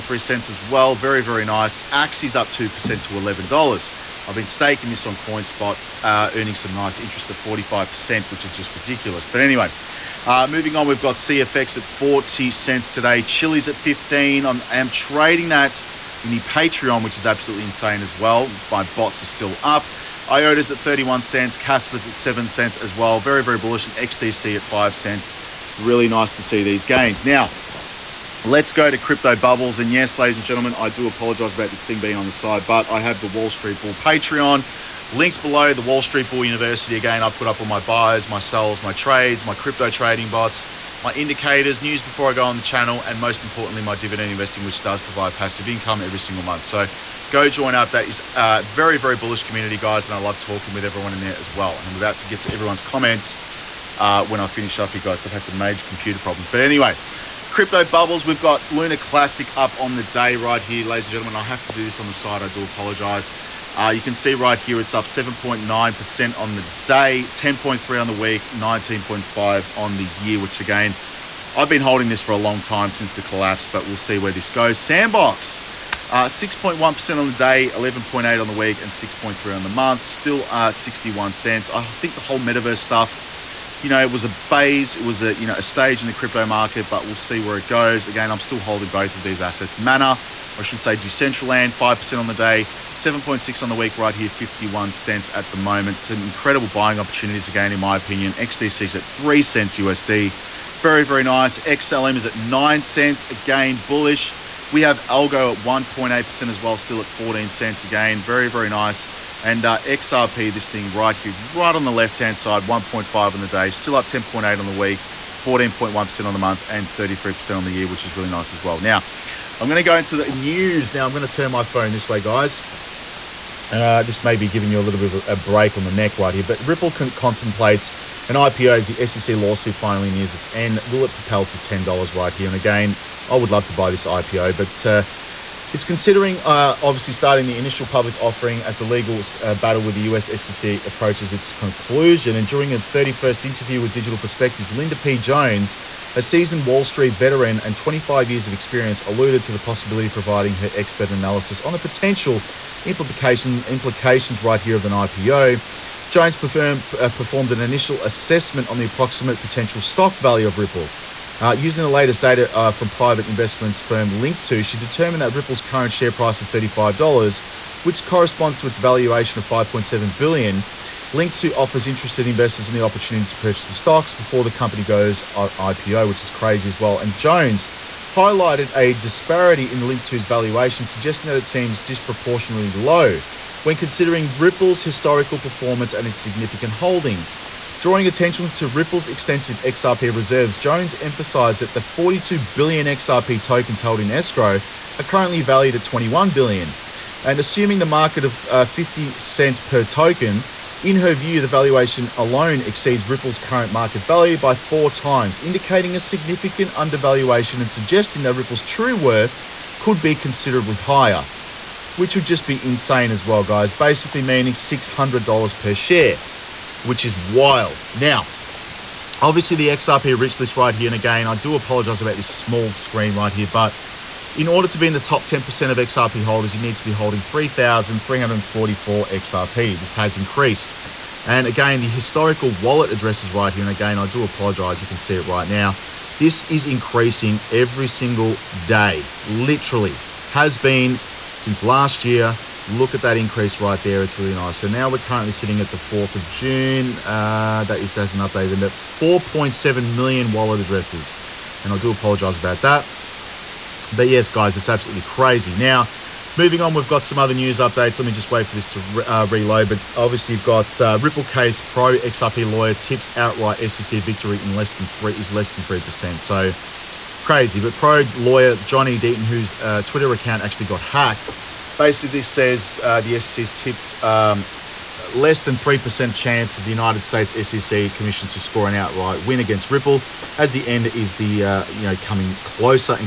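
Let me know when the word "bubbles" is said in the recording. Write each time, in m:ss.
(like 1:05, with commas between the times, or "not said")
0:29, 0:57.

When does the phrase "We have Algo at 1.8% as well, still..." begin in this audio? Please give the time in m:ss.
1:44.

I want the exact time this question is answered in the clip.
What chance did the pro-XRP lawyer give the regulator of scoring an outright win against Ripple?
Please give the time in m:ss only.
4:35.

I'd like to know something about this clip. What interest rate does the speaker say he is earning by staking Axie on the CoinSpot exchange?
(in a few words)
45%.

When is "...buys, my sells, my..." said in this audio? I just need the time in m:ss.
0:37.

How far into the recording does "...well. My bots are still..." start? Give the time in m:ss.
0:18.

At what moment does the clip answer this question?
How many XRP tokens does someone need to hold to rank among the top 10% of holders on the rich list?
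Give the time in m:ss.
3:47.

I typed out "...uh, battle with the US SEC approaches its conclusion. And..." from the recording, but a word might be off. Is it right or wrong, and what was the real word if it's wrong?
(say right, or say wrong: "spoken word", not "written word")
right.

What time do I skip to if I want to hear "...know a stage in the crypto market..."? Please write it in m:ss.
1:25.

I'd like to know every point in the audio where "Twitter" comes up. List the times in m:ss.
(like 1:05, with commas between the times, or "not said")
4:29.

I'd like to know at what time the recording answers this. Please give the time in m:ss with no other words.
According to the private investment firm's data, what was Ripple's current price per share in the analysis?
2:46.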